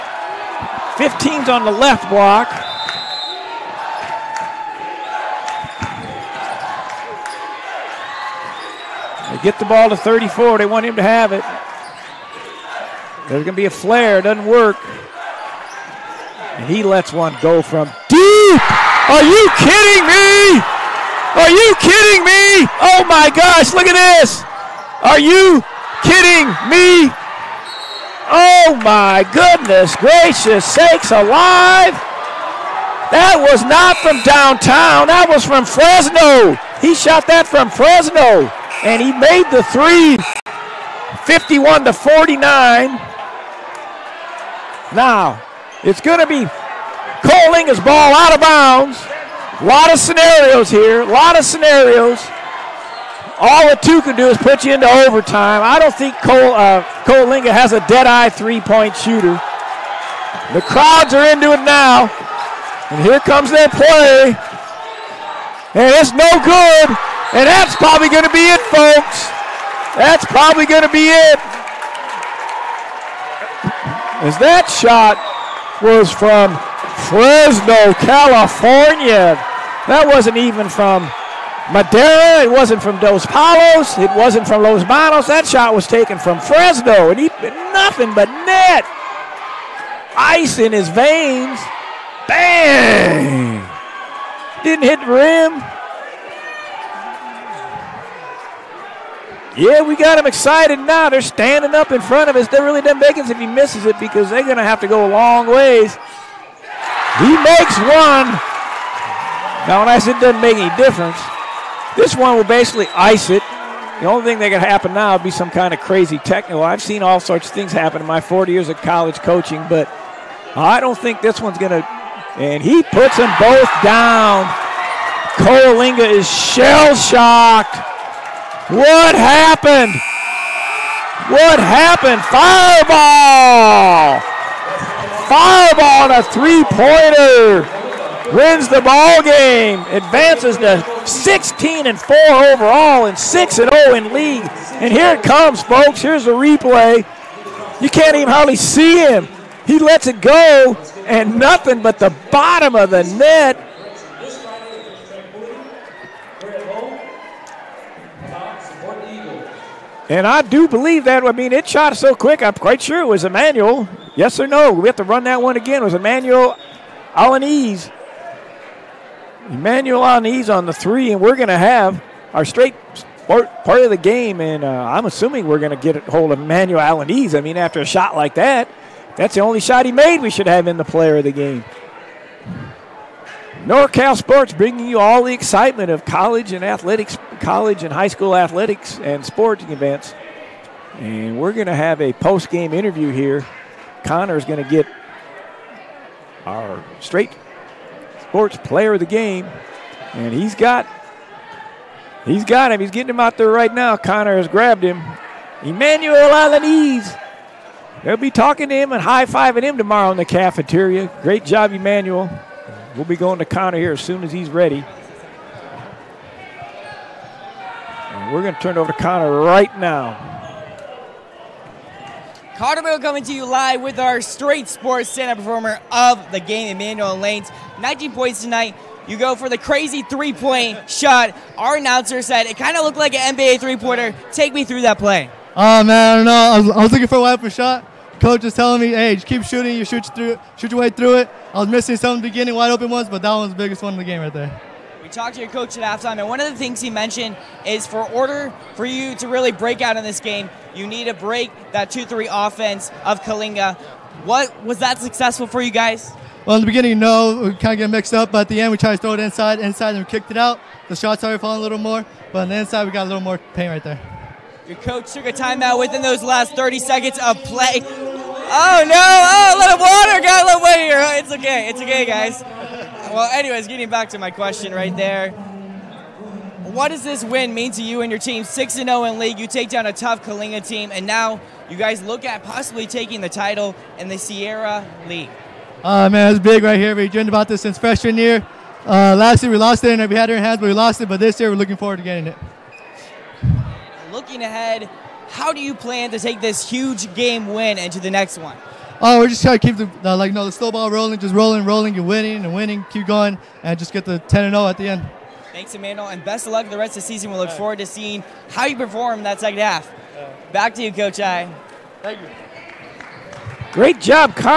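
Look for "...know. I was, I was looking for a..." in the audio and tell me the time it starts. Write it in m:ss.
3:56.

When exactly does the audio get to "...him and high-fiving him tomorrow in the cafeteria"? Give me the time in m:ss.
3:28.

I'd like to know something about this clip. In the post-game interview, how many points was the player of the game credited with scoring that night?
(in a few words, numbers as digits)
19.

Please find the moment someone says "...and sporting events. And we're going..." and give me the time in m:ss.
3:08.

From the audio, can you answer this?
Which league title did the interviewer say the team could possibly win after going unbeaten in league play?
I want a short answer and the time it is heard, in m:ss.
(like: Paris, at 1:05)
Sierra League, at 4:44.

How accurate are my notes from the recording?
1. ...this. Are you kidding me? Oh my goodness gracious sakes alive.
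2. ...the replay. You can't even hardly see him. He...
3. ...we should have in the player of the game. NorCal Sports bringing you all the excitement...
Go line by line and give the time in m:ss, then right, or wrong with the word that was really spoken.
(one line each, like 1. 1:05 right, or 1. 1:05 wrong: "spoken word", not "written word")
1. 0:23 right
2. 2:26 right
3. 3:00 right.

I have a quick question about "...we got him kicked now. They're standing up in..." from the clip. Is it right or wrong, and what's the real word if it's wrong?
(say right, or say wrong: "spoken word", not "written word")
wrong: "excited", not "kicked".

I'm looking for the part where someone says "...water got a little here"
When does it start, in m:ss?
4:29.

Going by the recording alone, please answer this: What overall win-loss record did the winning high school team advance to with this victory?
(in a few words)
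16 and 4.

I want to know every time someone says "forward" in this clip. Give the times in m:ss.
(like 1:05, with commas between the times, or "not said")
4:51, 5:07.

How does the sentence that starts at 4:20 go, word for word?
The shots started falling a little more, but on the inside, we got a little more pain right there.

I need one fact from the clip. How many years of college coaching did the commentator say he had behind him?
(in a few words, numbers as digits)
40.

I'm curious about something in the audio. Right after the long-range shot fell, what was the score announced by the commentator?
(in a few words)
51 to 49.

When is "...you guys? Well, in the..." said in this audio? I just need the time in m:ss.
4:15.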